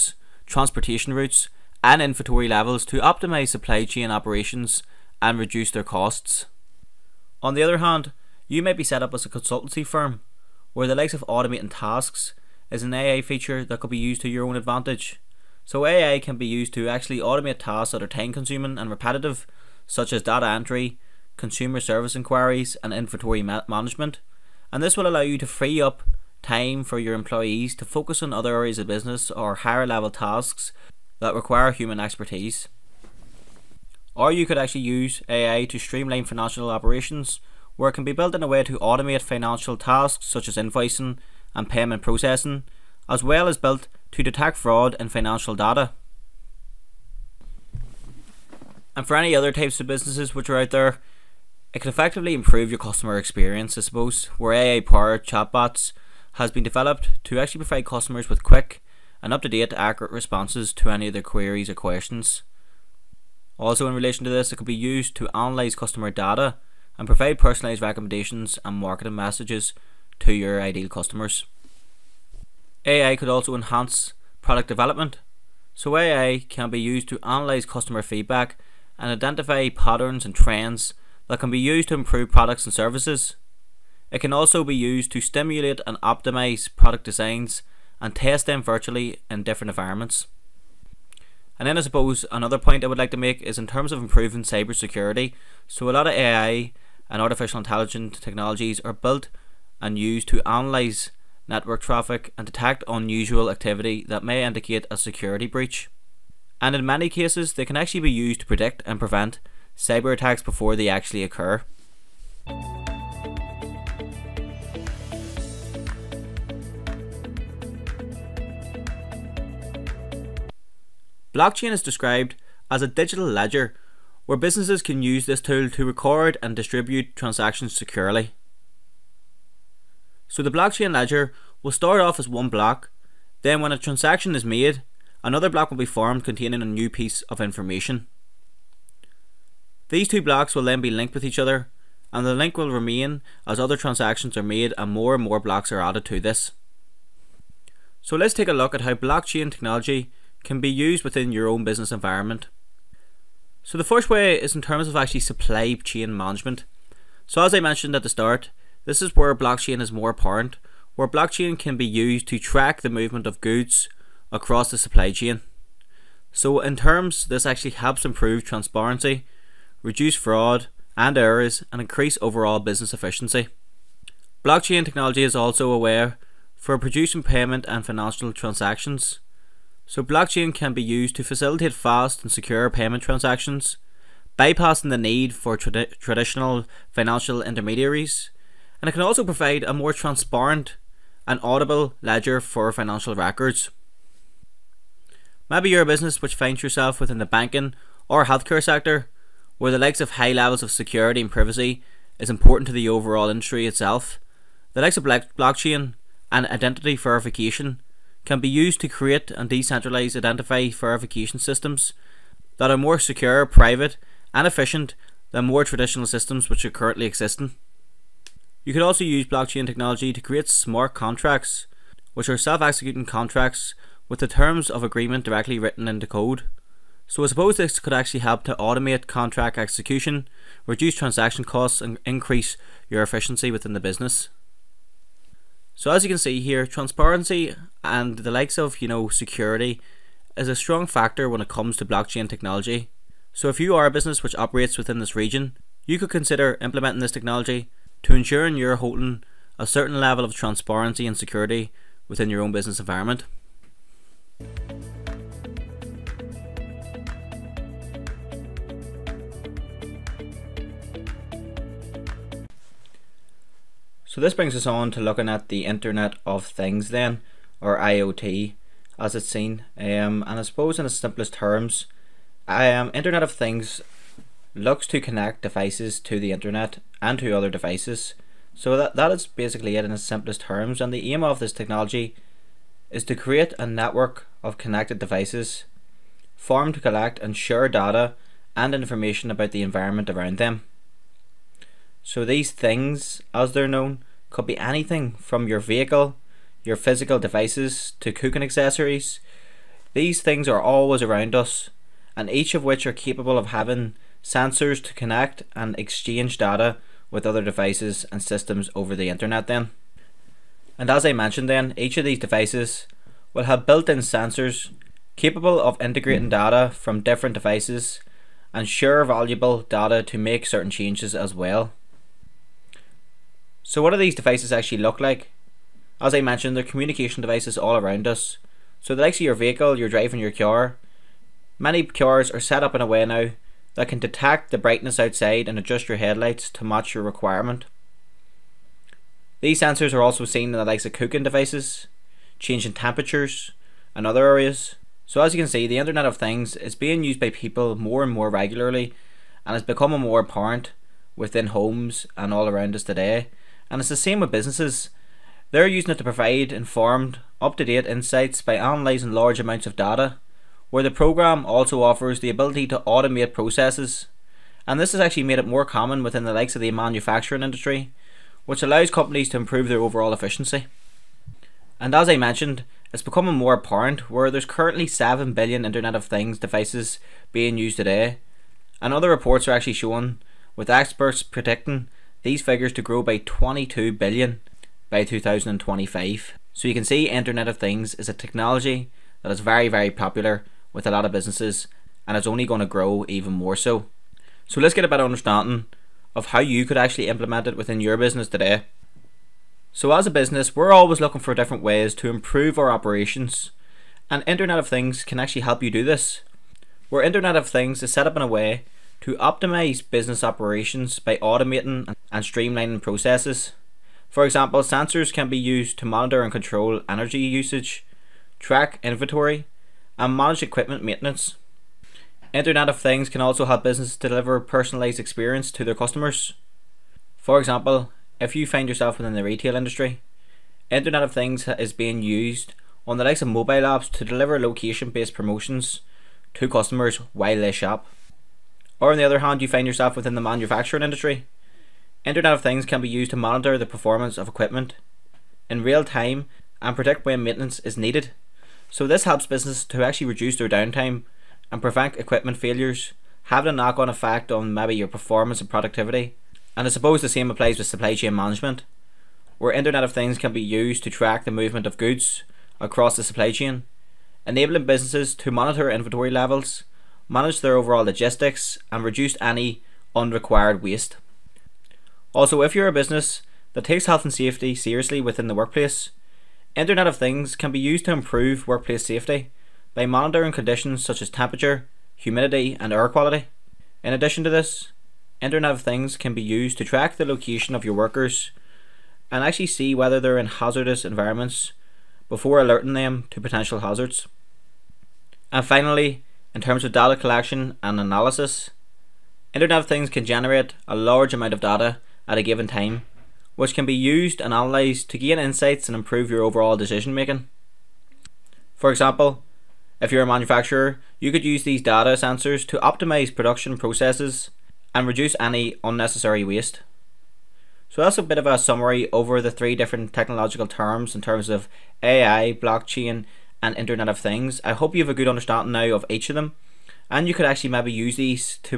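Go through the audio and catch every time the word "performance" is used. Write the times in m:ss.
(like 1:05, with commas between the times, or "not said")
7:23, 7:34.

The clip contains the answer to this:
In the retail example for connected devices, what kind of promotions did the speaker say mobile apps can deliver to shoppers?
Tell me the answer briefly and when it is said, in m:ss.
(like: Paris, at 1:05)
location based promotions, at 7:14.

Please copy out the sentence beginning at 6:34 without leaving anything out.
So let's get a better understanding of how you could actually implement it within your business today.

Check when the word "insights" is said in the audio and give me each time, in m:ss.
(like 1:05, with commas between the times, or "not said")
5:57, 8:25.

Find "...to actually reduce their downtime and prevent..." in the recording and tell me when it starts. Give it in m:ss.
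7:29.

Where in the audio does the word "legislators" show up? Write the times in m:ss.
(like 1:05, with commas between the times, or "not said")
not said.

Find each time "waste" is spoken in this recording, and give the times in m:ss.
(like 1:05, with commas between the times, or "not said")
7:50, 8:36.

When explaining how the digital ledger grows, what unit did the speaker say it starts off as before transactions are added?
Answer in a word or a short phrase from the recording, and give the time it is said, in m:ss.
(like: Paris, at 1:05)
one block, at 2:12.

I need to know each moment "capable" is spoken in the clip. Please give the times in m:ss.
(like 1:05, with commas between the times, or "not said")
5:02, 5:15.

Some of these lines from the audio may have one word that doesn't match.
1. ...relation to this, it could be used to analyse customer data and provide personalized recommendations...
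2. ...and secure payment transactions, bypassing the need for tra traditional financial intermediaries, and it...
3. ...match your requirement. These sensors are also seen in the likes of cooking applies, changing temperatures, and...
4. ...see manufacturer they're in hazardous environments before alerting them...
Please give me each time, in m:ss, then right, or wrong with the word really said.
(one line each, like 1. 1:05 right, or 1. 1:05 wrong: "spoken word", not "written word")
1. 1:03 right
2. 3:02 right
3. 5:36 wrong: "devices", not "applies"
4. 8:09 wrong: "whether", not "manufacturer".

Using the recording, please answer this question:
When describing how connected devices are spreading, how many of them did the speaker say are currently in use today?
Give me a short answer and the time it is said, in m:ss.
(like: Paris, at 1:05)
7 billion, at 6:14.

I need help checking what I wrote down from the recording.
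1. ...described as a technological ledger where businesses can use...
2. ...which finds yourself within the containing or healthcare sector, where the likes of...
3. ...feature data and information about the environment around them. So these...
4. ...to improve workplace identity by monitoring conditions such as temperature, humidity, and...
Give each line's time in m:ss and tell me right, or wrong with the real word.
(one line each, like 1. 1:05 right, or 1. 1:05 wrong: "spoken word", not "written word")
1. 2:01 wrong: "digital", not "technological"
2. 3:16 wrong: "banking", not "containing"
3. 4:47 wrong: "share", not "feature"
4. 7:57 wrong: "safety", not "identity".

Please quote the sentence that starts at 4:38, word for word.
So that, that is basically it in its simplest terms.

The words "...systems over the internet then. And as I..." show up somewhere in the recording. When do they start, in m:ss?
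5:08.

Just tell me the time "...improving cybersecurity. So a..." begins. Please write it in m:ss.
1:33.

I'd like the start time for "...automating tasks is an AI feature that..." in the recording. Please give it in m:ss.
0:11.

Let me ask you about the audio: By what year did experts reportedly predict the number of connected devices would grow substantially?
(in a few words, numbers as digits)
2025.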